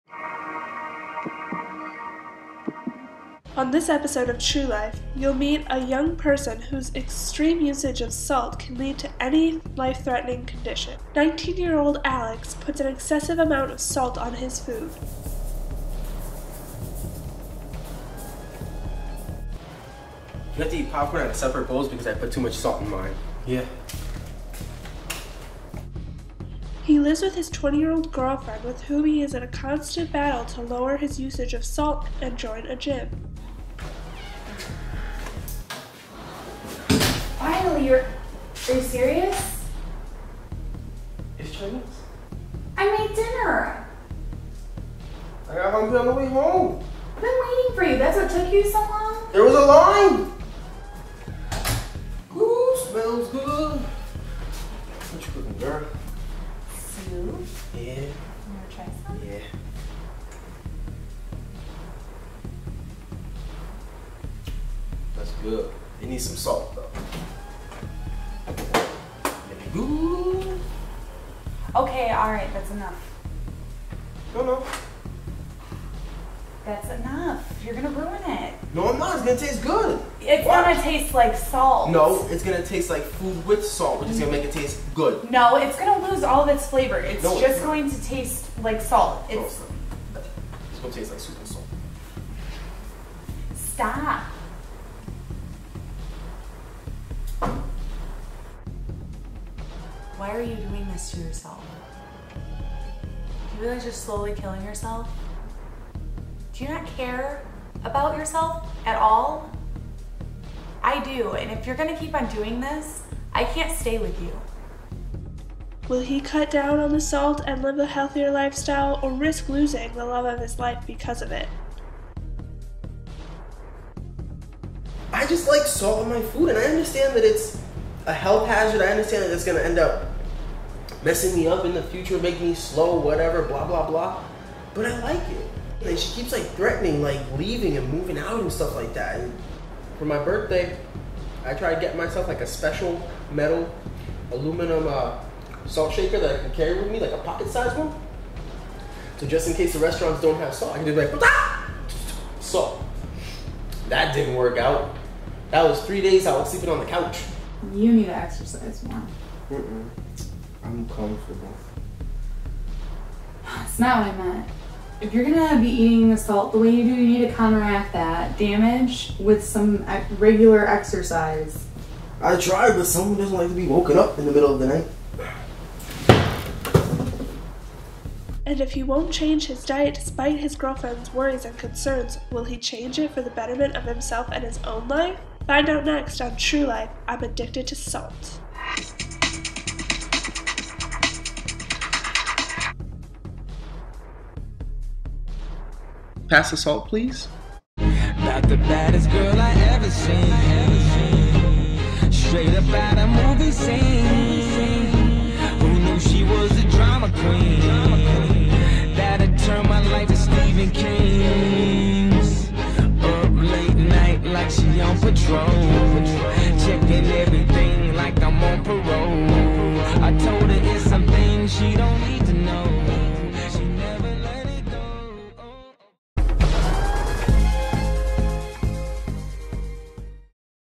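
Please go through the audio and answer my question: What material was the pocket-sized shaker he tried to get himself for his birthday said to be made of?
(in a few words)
aluminum.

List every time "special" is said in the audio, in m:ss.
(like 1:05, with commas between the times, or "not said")
2:22.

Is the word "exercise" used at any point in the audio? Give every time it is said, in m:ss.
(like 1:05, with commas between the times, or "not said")
2:38, 2:50.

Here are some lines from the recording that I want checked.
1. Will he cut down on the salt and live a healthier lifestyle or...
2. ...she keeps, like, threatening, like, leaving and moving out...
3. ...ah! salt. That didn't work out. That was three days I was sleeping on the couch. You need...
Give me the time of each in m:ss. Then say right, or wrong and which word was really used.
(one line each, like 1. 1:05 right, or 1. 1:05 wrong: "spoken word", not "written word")
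1. 1:55 right
2. 2:15 right
3. 2:31 right.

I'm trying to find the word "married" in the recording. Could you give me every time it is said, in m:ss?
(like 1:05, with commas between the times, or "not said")
not said.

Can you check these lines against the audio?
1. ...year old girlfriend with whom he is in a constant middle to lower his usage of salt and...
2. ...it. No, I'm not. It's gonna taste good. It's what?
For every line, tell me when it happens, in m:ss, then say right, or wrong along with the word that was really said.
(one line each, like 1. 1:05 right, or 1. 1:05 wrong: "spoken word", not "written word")
1. 0:27 wrong: "battle", not "middle"
2. 1:18 right.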